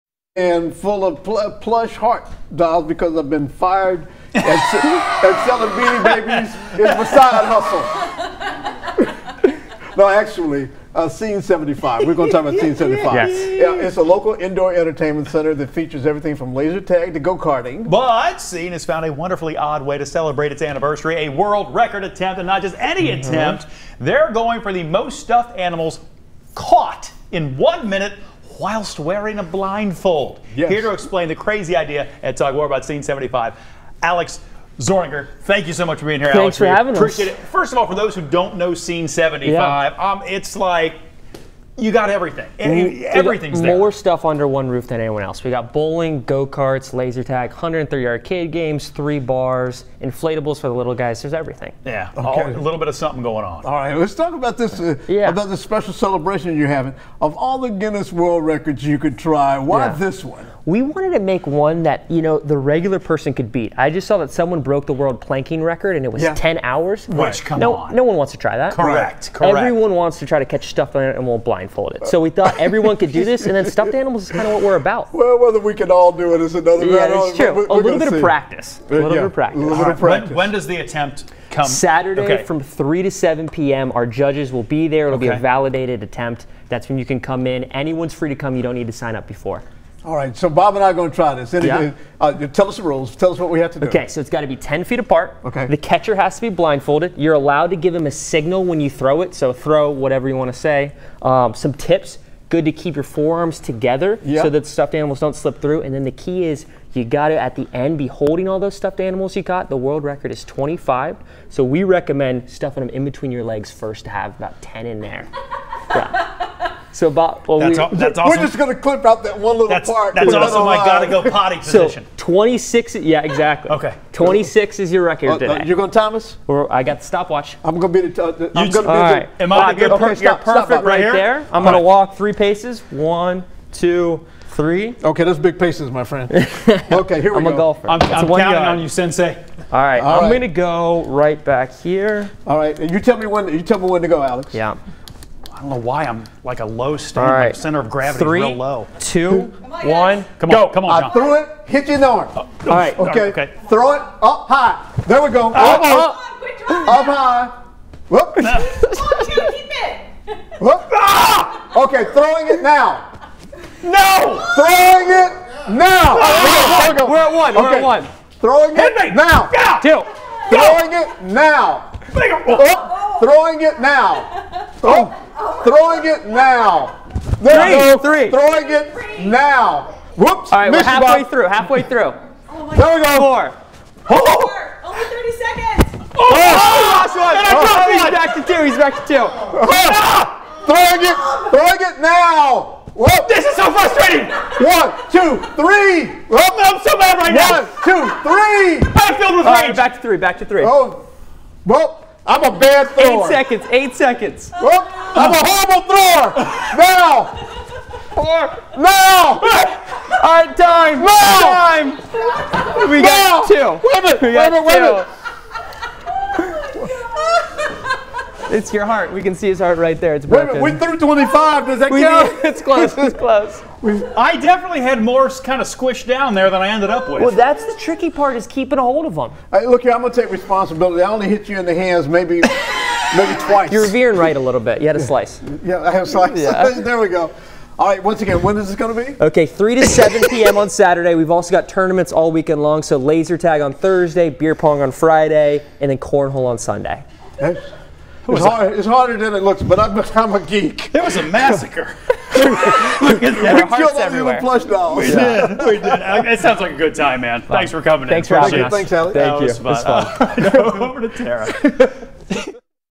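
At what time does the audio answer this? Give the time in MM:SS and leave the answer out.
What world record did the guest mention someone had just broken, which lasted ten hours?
01:04.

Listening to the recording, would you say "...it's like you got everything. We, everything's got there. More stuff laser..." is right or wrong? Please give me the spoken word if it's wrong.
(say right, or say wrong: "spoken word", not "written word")
wrong: "under", not "laser".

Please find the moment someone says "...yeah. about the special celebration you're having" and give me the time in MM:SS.
00:55.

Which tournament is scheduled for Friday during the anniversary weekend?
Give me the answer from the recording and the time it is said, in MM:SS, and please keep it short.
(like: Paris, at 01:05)
Beer pong, at 04:04.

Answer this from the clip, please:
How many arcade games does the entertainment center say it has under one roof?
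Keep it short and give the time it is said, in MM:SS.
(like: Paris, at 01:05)
103, at 00:47.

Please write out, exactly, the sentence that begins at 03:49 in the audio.
Right, look here, I'm going to take responsibility.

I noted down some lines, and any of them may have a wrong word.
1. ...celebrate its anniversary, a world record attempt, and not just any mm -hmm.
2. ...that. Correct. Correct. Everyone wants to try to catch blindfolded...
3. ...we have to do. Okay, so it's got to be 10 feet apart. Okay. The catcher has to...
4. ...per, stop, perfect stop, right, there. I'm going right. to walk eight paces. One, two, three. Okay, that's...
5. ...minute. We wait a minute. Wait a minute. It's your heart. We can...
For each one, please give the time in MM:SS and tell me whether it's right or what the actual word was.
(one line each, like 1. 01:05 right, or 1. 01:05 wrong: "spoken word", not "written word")
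1. 00:20 right
2. 01:08 wrong: "stuffed", not "blindfolded"
3. 01:33 right
4. 02:09 wrong: "three", not "eight"
5. 03:34 right.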